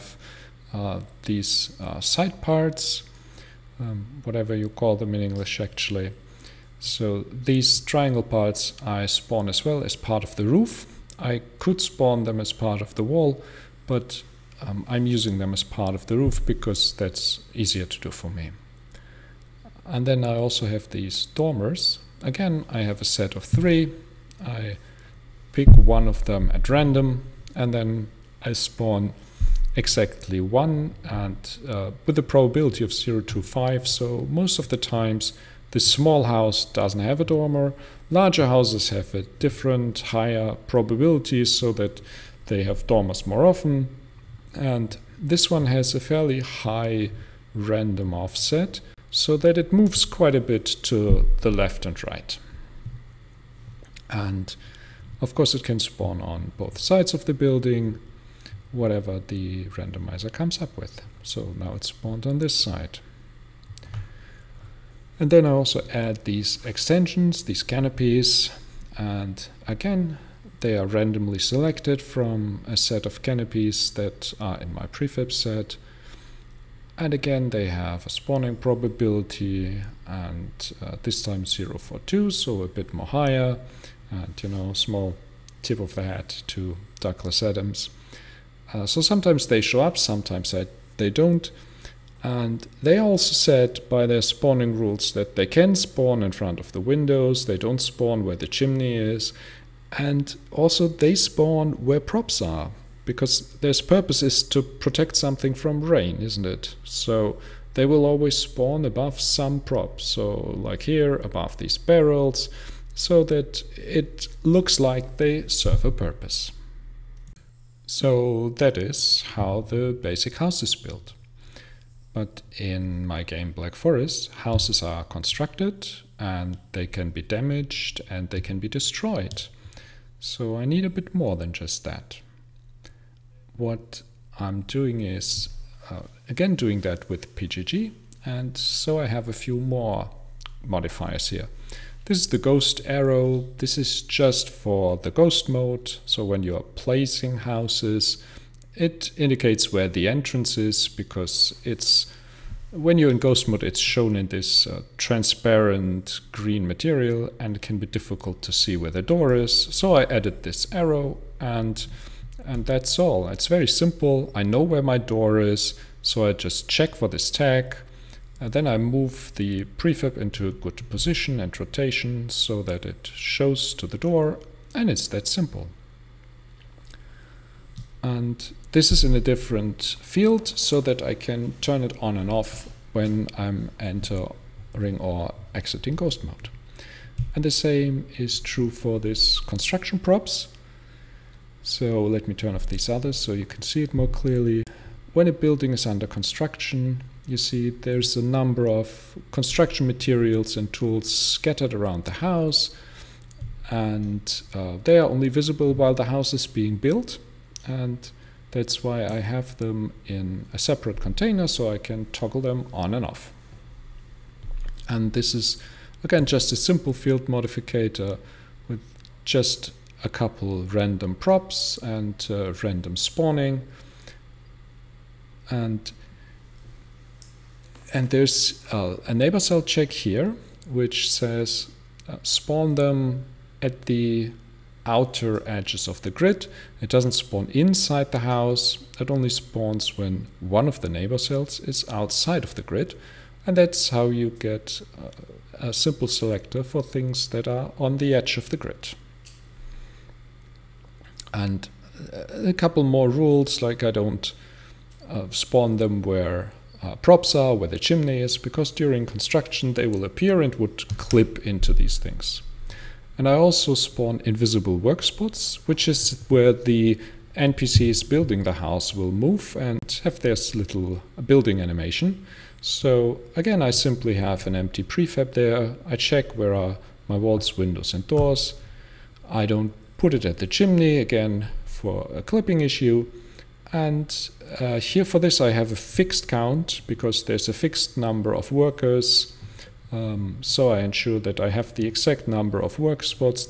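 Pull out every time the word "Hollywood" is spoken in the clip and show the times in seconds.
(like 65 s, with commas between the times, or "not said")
not said.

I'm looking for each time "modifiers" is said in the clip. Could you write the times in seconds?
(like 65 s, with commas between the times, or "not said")
140 s, 217 s.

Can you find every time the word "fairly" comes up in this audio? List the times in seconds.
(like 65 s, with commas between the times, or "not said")
45 s.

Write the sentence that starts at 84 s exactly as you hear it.
And, you know, small tip of the hat to Douglas Adams.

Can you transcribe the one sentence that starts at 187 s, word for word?
And the same is true for this construction props.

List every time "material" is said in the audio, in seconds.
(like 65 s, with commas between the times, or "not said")
156 s, 199 s.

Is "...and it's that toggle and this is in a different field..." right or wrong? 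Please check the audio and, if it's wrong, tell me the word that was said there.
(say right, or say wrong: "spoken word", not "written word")
wrong: "simple", not "toggle".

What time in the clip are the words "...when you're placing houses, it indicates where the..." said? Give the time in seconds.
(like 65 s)
146 s.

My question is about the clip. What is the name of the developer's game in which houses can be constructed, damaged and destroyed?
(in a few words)
Black Forest.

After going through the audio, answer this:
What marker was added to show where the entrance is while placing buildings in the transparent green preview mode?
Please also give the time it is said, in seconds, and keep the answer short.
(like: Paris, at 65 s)
ghost arrow, at 142 s.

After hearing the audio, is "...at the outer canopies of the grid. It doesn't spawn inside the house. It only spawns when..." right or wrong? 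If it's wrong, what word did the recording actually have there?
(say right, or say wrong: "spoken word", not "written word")
wrong: "edges", not "canopies".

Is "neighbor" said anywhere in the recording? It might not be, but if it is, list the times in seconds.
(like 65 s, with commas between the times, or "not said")
229 s, 240 s.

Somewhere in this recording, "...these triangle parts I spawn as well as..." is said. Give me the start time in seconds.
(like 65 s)
7 s.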